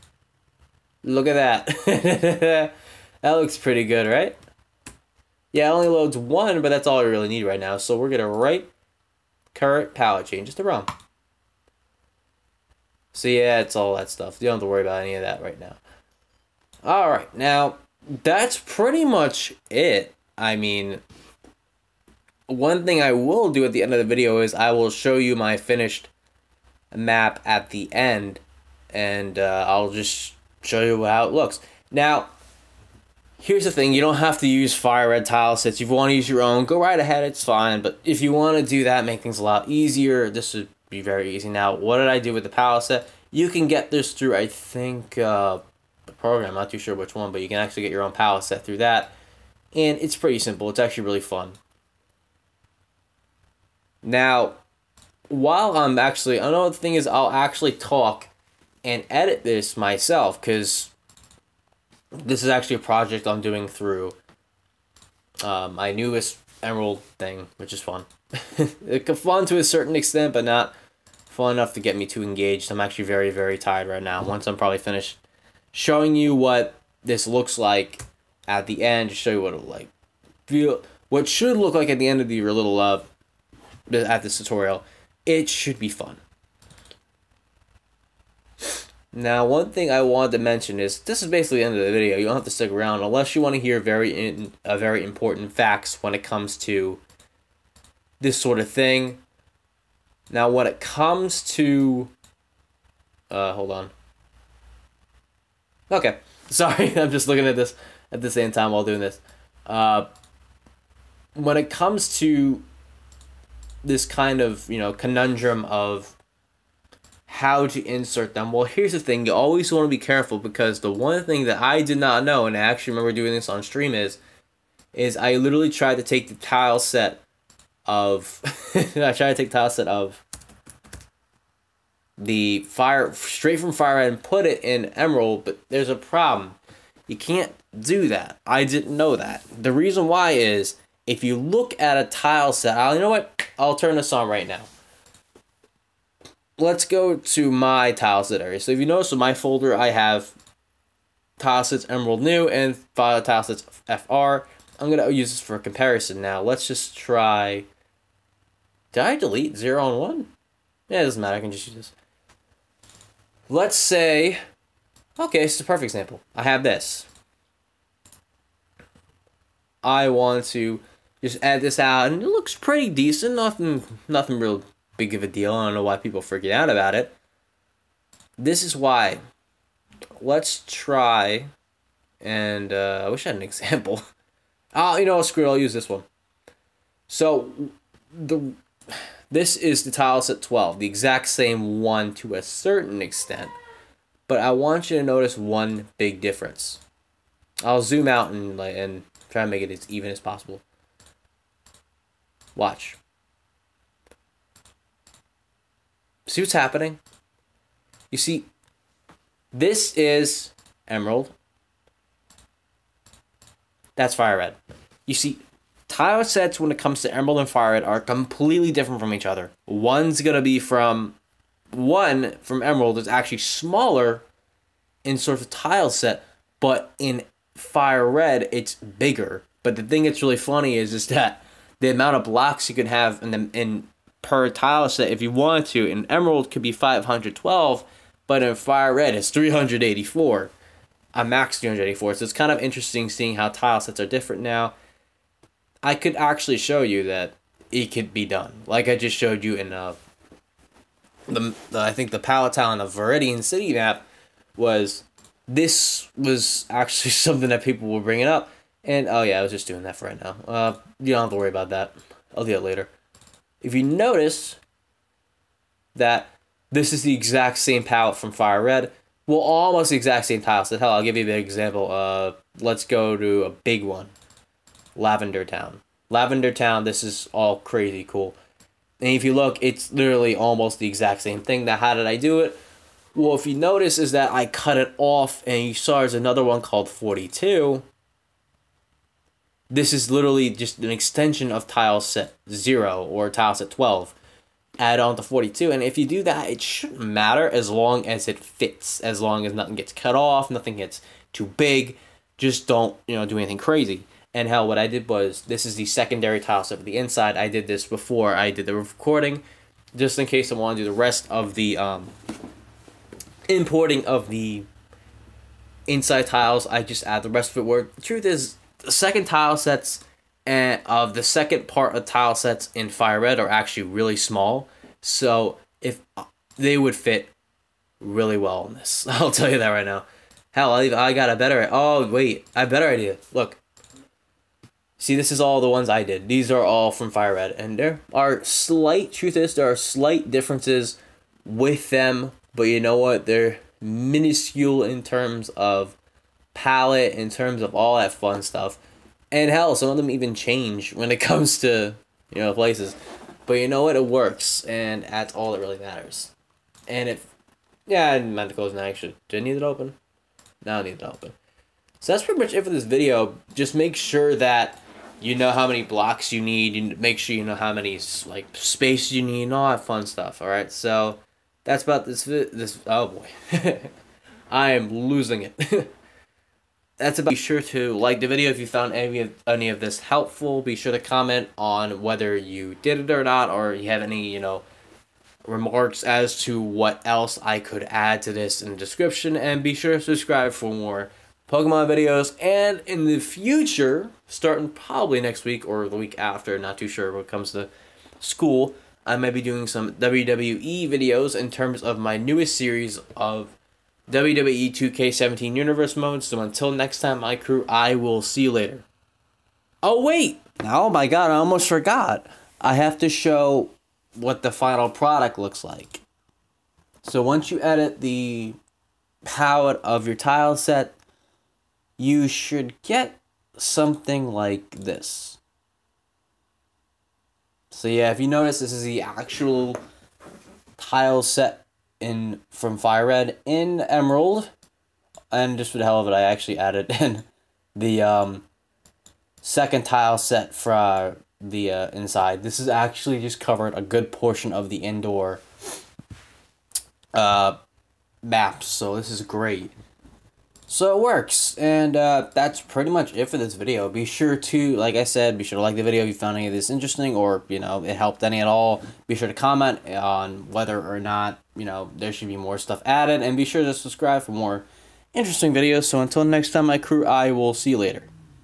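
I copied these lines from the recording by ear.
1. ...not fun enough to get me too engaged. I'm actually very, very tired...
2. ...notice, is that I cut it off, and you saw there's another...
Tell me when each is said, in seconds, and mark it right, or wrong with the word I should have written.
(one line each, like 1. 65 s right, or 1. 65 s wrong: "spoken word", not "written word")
1. 70 s right
2. 283 s right.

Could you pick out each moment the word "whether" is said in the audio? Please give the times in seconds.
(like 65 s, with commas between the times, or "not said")
382 s, 460 s.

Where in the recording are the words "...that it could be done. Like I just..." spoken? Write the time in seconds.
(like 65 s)
247 s.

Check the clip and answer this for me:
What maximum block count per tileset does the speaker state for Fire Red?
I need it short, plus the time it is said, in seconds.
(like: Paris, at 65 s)
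384, at 241 s.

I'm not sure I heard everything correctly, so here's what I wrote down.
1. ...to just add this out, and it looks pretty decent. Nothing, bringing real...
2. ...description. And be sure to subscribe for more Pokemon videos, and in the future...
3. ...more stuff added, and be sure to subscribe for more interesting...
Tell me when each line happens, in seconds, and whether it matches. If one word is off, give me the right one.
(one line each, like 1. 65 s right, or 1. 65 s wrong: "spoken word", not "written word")
1. 170 s wrong: "nothing", not "bringing"
2. 388 s right
3. 462 s right.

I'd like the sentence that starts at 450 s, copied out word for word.
So it works, and uh, that's pretty much it for this video.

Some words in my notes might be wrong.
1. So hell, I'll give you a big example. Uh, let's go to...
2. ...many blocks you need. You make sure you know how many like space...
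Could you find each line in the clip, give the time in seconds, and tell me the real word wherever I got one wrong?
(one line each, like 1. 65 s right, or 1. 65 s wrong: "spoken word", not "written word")
1. 270 s right
2. 365 s right.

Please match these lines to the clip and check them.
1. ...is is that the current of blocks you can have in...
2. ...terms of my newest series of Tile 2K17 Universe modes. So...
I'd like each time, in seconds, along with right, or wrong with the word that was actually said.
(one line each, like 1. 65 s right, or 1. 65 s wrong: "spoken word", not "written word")
1. 230 s wrong: "amount", not "current"
2. 401 s wrong: "WWE", not "Tile".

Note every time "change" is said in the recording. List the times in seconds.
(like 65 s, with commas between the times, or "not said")
10 s, 350 s.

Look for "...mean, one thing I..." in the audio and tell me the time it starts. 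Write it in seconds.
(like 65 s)
20 s.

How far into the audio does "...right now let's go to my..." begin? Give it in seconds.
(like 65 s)
144 s.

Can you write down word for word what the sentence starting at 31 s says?
Now, here's the thing: you don't have to use fire red tile sets.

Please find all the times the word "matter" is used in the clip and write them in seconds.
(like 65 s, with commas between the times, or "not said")
161 s, 297 s, 355 s.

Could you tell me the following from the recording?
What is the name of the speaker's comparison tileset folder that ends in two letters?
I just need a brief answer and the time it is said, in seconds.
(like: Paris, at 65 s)
tile sets fr, at 152 s.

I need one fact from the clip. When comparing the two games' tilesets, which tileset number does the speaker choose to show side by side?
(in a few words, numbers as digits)
12.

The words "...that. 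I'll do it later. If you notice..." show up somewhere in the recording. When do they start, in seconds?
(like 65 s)
261 s.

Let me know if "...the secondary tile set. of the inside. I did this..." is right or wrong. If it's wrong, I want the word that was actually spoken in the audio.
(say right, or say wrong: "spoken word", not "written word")
right.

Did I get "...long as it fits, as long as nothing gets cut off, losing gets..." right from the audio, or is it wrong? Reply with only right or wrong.
wrong.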